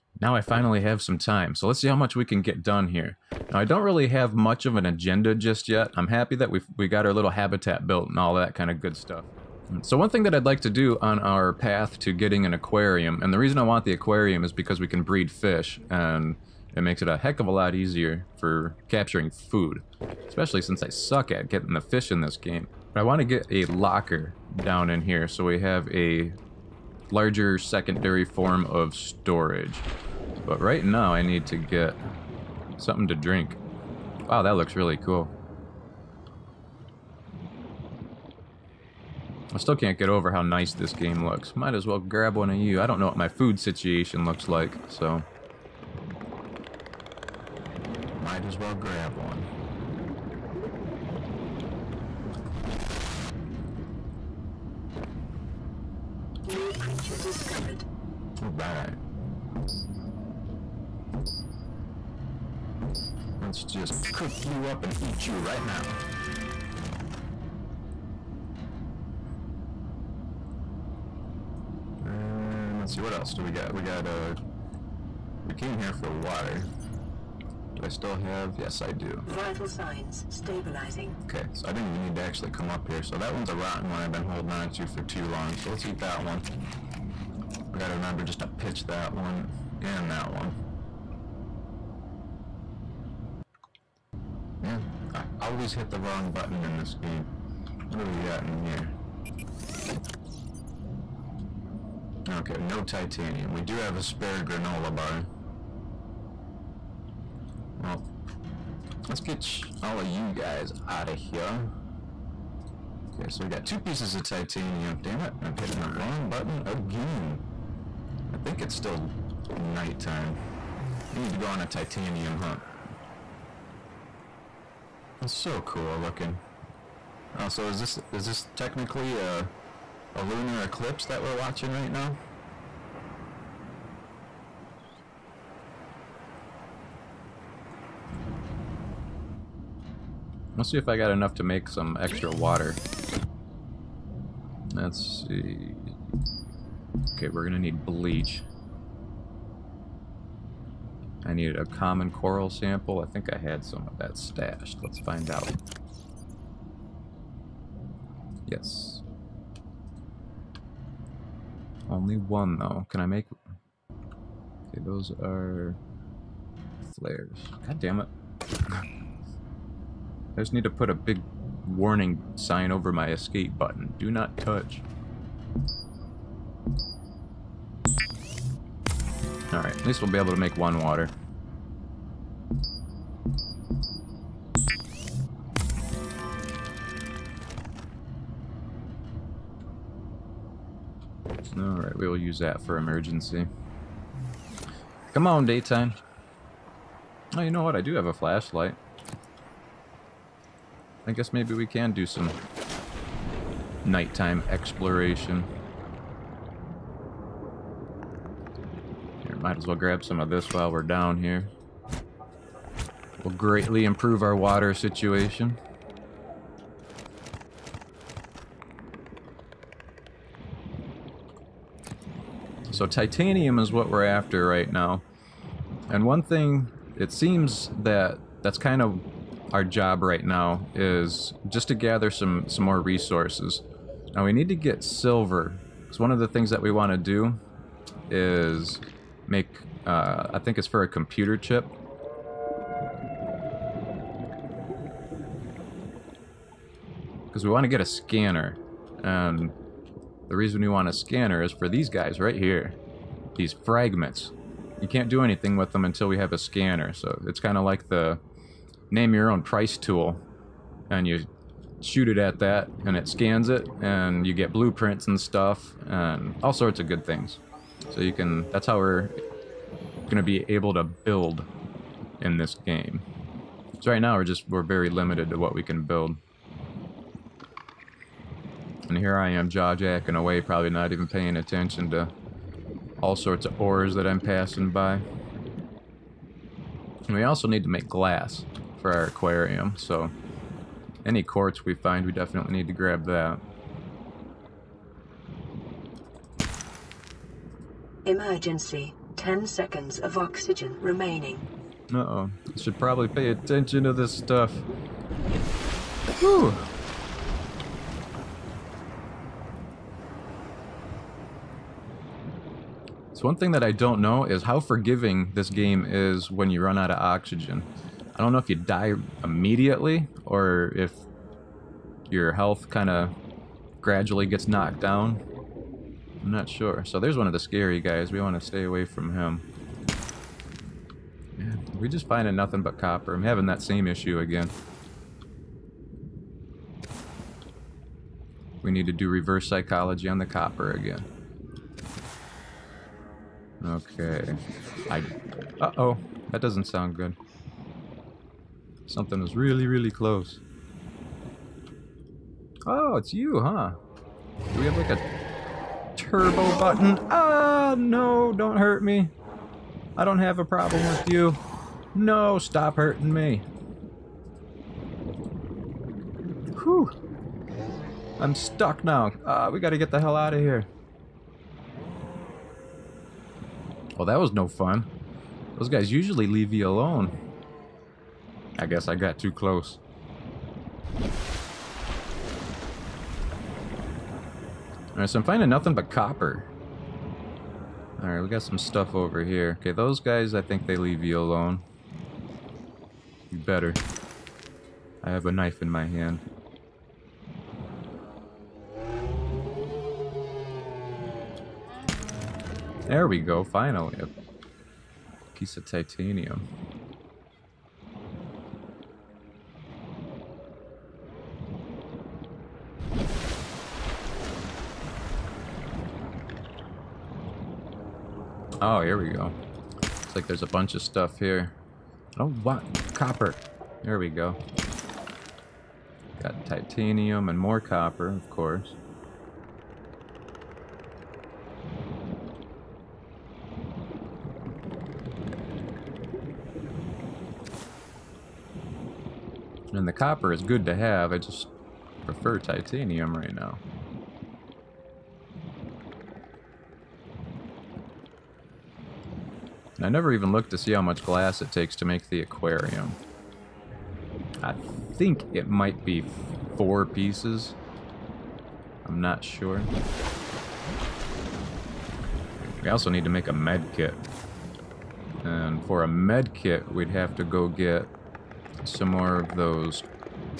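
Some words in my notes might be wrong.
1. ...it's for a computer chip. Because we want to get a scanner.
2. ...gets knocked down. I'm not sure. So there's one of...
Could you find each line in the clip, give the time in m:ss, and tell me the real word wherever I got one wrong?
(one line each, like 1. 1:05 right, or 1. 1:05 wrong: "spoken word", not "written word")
1. 4:00 right
2. 5:24 right.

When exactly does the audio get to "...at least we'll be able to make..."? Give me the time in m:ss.
2:59.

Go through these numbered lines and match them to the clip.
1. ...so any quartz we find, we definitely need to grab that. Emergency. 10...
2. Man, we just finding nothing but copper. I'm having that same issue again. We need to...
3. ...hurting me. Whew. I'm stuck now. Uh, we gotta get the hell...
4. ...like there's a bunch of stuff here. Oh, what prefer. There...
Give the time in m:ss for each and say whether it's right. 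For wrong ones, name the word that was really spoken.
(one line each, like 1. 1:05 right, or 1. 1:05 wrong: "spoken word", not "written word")
1. 4:49 right
2. 5:31 right
3. 6:02 right
4. 7:00 wrong: "copper", not "prefer".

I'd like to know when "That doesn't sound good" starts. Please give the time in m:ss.
5:46.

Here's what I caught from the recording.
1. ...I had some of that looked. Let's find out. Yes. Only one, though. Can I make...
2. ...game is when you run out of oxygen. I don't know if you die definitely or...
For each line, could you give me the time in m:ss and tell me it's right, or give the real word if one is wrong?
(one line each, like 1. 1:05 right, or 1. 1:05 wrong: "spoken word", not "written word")
1. 2:33 wrong: "stashed", not "looked"
2. 5:15 wrong: "immediately", not "definitely".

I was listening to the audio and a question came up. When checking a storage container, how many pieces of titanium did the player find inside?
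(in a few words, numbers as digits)
2.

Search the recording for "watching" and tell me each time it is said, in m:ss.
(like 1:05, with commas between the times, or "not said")
2:11.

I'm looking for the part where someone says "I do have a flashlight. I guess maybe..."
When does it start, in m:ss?
3:17.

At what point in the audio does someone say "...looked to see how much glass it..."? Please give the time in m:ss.
7:30.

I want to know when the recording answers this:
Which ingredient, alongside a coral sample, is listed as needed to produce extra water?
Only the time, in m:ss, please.
2:27.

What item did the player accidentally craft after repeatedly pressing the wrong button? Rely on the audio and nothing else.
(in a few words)
Flares.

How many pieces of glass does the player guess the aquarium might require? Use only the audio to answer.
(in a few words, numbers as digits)
4.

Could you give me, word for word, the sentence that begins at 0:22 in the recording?
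But I want to get a locker down in here so we have a larger secondary form of storage.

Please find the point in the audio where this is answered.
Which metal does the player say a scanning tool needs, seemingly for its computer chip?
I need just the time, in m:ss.
3:54.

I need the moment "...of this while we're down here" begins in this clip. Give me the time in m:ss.
3:30.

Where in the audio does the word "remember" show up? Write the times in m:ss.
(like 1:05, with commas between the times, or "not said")
1:27.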